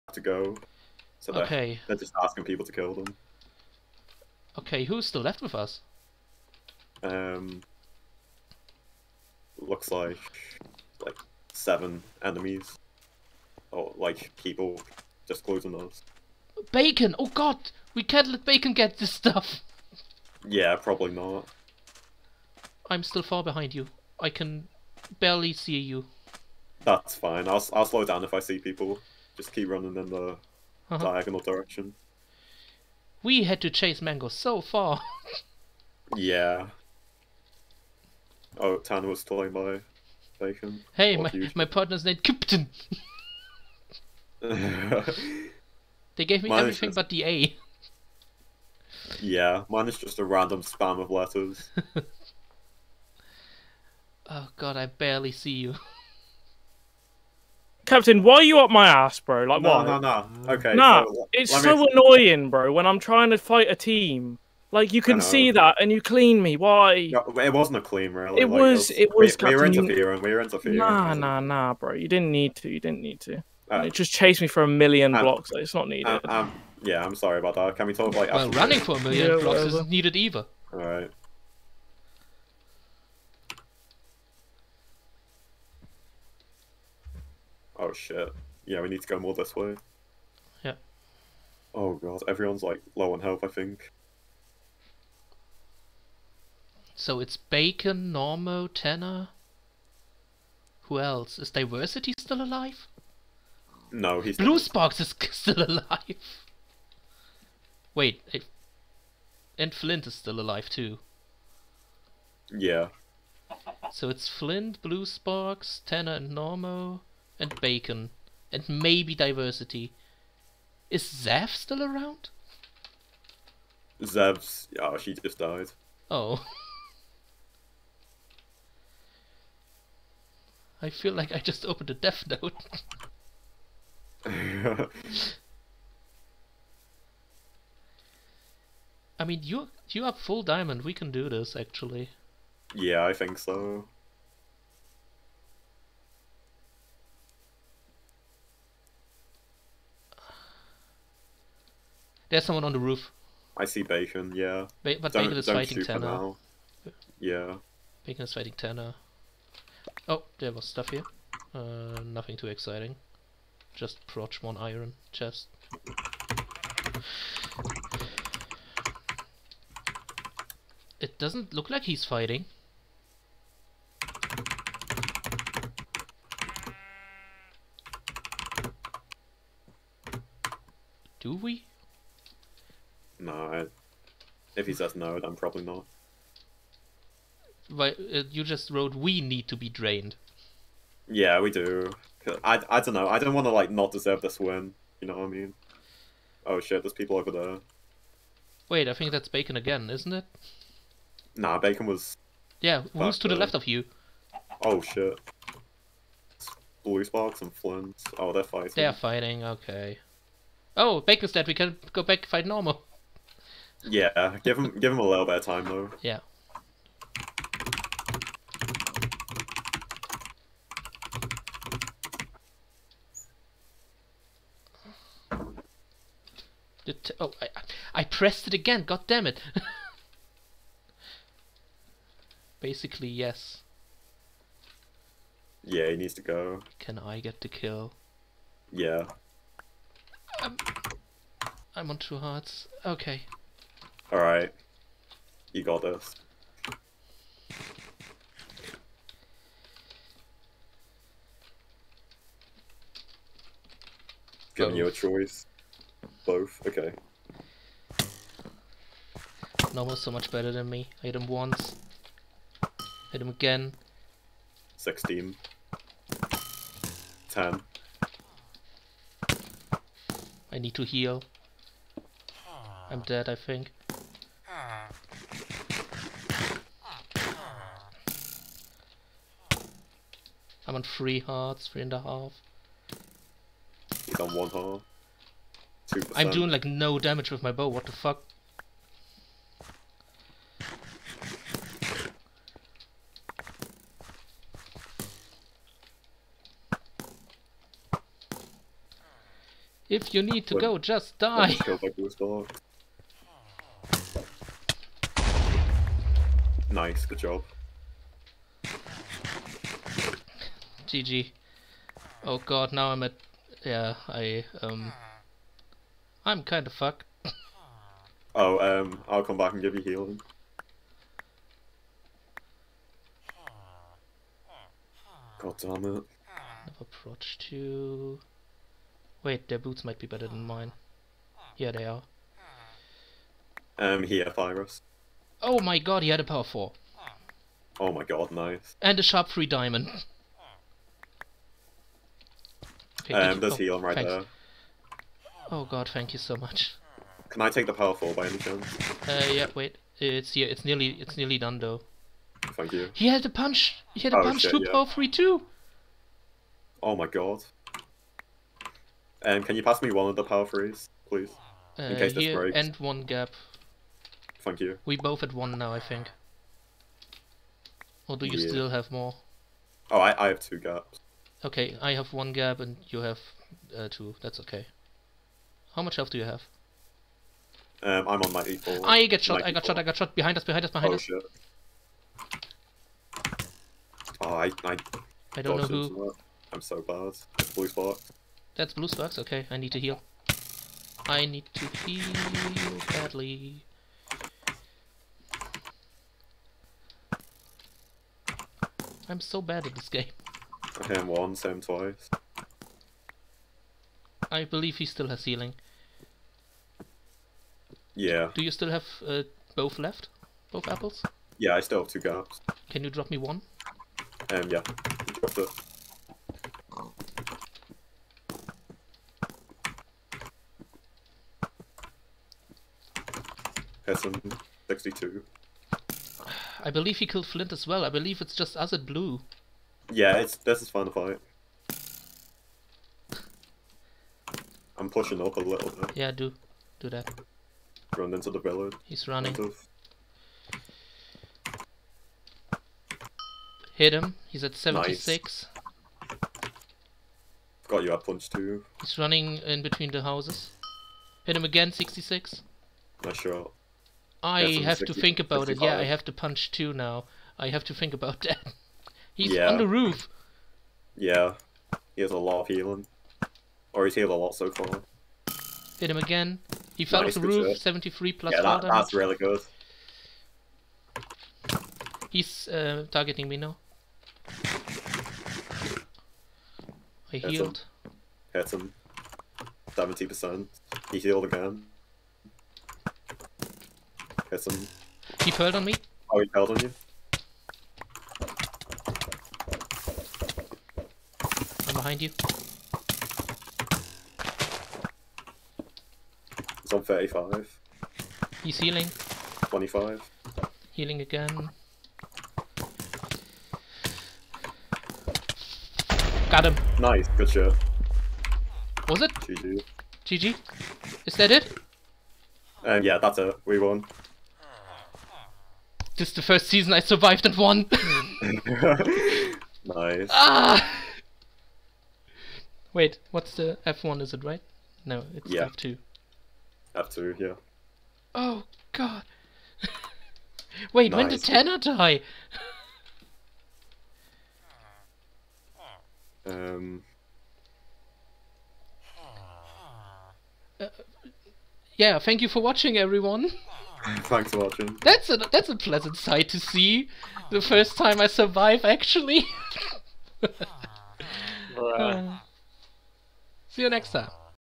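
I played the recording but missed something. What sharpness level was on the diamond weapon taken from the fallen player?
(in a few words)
3.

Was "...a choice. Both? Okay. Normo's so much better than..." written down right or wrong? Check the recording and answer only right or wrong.
right.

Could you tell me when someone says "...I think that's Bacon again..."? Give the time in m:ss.
3:18.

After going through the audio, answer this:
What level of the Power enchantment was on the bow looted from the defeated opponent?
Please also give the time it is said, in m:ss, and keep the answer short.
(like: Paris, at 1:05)
4, at 5:36.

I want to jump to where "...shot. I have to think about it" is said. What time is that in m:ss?
7:33.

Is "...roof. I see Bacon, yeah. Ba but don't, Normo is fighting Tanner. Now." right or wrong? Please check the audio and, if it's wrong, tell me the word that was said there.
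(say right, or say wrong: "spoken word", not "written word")
wrong: "Bacon", not "Normo".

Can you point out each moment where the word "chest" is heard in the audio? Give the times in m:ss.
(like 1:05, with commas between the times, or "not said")
2:45.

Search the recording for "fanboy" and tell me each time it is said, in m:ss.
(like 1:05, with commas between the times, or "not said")
not said.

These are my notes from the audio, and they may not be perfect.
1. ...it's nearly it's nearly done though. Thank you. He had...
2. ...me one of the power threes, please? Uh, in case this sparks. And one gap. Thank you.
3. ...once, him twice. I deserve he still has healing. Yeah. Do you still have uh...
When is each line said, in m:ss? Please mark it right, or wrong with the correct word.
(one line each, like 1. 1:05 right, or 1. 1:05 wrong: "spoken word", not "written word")
1. 5:50 right
2. 5:59 wrong: "breaks", not "sparks"
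3. 6:41 wrong: "believe", not "deserve".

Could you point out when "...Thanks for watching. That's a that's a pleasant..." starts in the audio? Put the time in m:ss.
9:03.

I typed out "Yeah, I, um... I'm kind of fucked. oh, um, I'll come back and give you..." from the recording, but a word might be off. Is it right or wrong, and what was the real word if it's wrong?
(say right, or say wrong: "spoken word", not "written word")
right.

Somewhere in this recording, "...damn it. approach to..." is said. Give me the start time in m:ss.
5:25.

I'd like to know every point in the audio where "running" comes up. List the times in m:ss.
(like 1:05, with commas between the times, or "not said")
0:29, 1:18, 7:19, 7:28.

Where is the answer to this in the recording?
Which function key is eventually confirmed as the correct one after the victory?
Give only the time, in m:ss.
8:46.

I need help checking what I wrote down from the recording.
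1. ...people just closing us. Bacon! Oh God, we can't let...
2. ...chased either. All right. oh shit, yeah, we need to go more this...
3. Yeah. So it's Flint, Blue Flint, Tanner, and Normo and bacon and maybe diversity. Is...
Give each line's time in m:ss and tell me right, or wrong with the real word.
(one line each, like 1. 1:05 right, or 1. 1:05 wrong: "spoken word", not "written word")
1. 0:14 right
2. 1:19 wrong: "needed", not "chased"
3. 1:52 wrong: "Sparks", not "Flint".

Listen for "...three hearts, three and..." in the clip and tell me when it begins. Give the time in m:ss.
4:40.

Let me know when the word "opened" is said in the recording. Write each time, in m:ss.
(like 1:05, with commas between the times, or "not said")
2:11.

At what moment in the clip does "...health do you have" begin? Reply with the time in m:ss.
6:15.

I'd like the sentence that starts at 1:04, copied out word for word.
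Like, you can see that, and you clean me.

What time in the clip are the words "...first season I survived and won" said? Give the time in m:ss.
8:36.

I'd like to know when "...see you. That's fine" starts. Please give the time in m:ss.
0:25.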